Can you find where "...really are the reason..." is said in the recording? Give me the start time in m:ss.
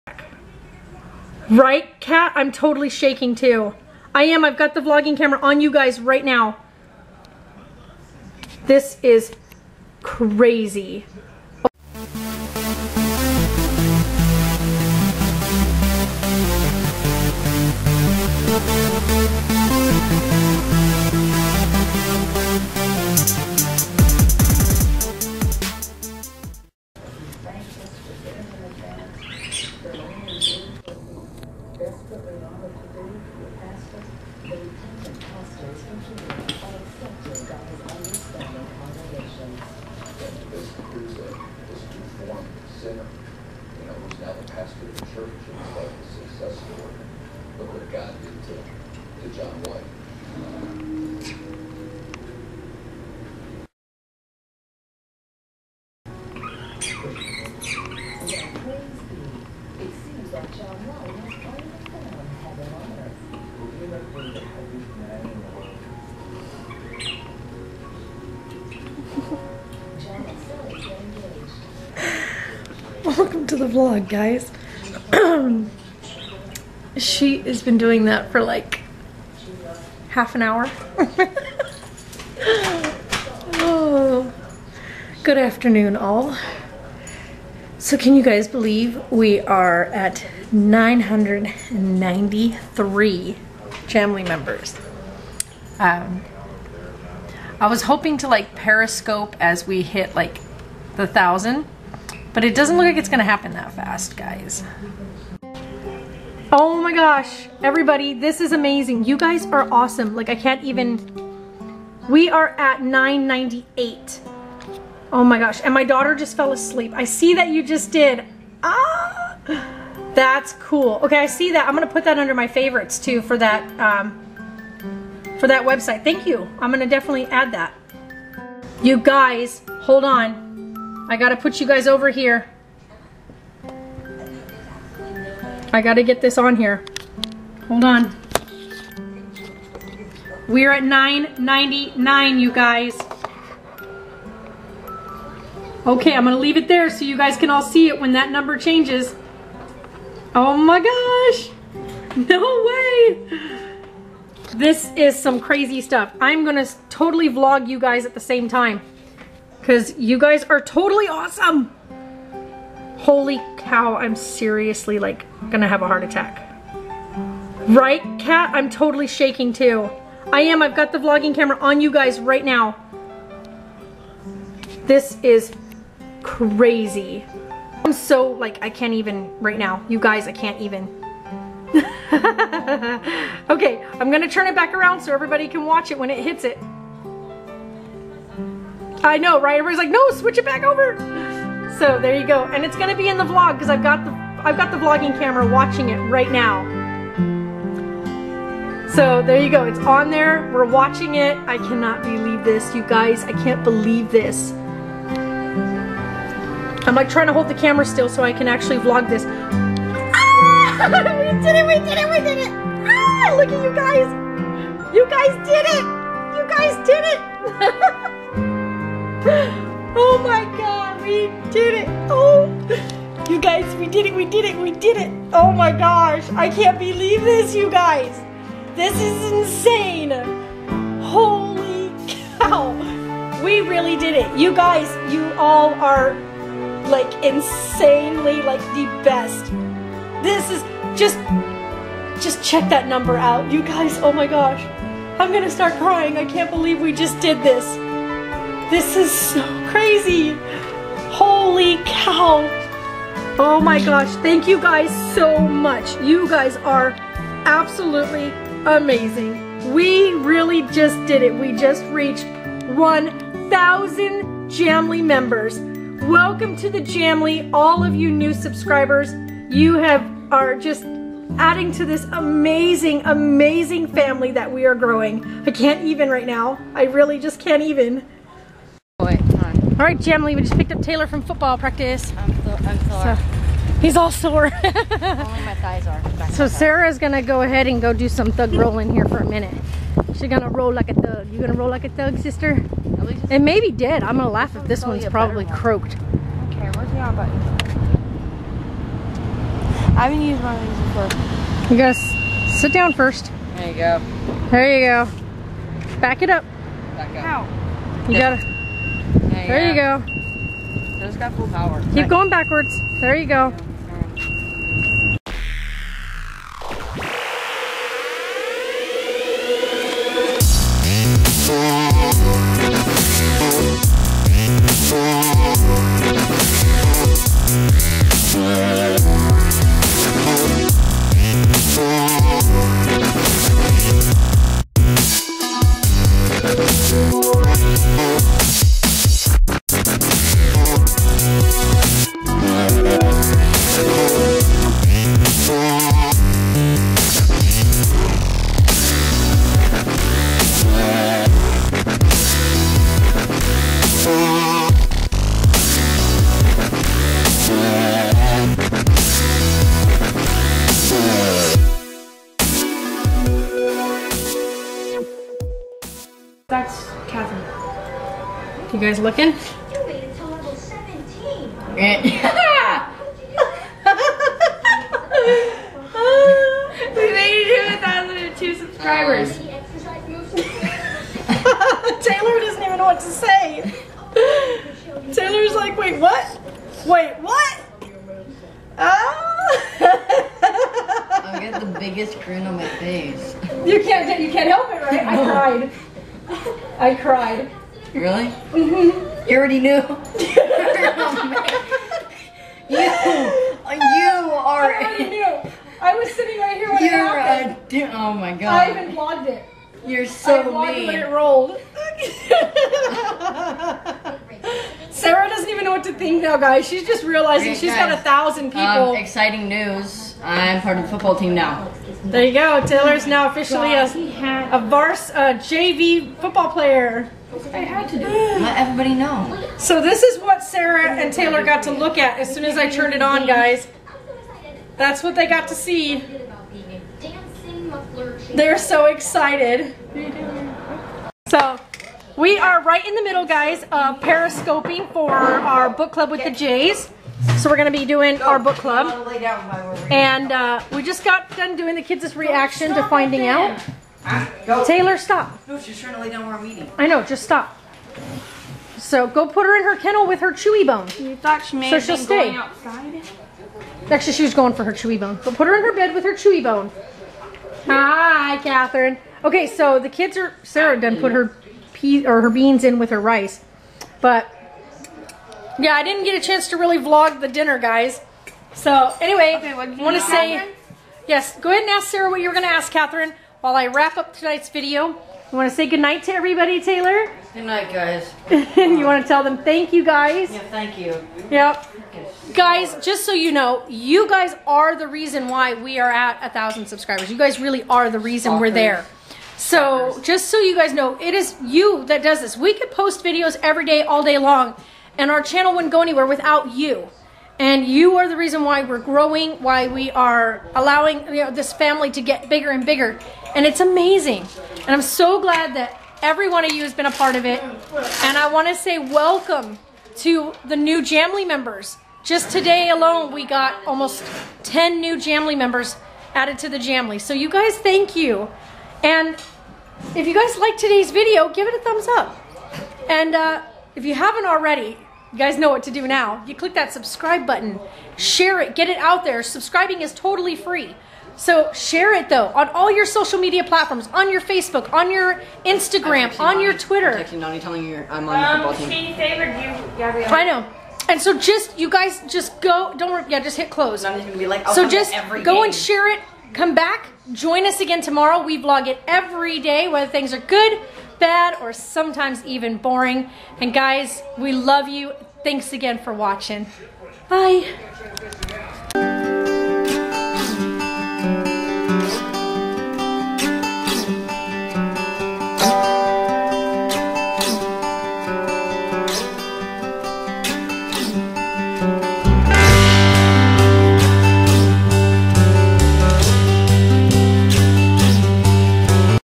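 8:17.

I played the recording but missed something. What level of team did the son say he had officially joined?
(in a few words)
JV.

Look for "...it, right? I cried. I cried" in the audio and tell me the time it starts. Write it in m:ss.
6:34.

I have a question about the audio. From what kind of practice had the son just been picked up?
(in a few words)
Football practice.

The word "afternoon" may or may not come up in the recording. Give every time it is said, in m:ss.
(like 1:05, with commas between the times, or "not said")
1:25.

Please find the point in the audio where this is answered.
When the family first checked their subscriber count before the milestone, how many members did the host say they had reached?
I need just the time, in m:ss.
1:30.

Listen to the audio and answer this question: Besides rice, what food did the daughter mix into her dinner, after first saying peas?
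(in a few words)
Beans.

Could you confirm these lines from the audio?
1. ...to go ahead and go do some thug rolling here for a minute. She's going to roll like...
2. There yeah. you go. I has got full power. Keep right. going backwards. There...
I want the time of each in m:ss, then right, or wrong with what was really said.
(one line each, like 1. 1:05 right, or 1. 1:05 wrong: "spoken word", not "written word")
1. 4:47 right
2. 5:09 right.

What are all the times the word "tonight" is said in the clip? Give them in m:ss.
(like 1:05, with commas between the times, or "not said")
8:04.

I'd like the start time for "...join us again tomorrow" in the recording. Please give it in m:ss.
9:17.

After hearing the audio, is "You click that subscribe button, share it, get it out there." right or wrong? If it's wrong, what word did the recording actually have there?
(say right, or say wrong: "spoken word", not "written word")
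right.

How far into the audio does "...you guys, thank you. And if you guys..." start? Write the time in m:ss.
8:47.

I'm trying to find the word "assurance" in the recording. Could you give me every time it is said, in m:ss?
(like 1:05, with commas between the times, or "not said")
not said.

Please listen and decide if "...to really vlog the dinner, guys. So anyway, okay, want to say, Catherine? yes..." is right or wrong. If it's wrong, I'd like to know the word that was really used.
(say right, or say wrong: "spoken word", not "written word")
right.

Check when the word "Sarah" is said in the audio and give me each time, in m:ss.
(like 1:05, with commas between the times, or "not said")
4:46, 6:54, 7:10, 7:50, 8:01.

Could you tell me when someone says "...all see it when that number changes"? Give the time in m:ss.
2:27.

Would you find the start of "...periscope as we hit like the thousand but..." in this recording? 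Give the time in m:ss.
1:38.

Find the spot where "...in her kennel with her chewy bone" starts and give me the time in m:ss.
7:39.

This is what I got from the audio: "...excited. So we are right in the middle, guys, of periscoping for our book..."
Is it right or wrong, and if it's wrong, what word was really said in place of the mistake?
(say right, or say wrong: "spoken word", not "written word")
right.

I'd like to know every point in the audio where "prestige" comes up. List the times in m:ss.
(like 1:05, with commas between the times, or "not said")
not said.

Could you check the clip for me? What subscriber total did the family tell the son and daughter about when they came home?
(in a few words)
1,002.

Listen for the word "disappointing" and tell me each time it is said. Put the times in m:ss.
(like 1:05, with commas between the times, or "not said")
not said.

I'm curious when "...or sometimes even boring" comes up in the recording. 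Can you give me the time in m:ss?
9:21.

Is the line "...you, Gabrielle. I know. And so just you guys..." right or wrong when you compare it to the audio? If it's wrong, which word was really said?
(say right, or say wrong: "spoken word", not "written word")
right.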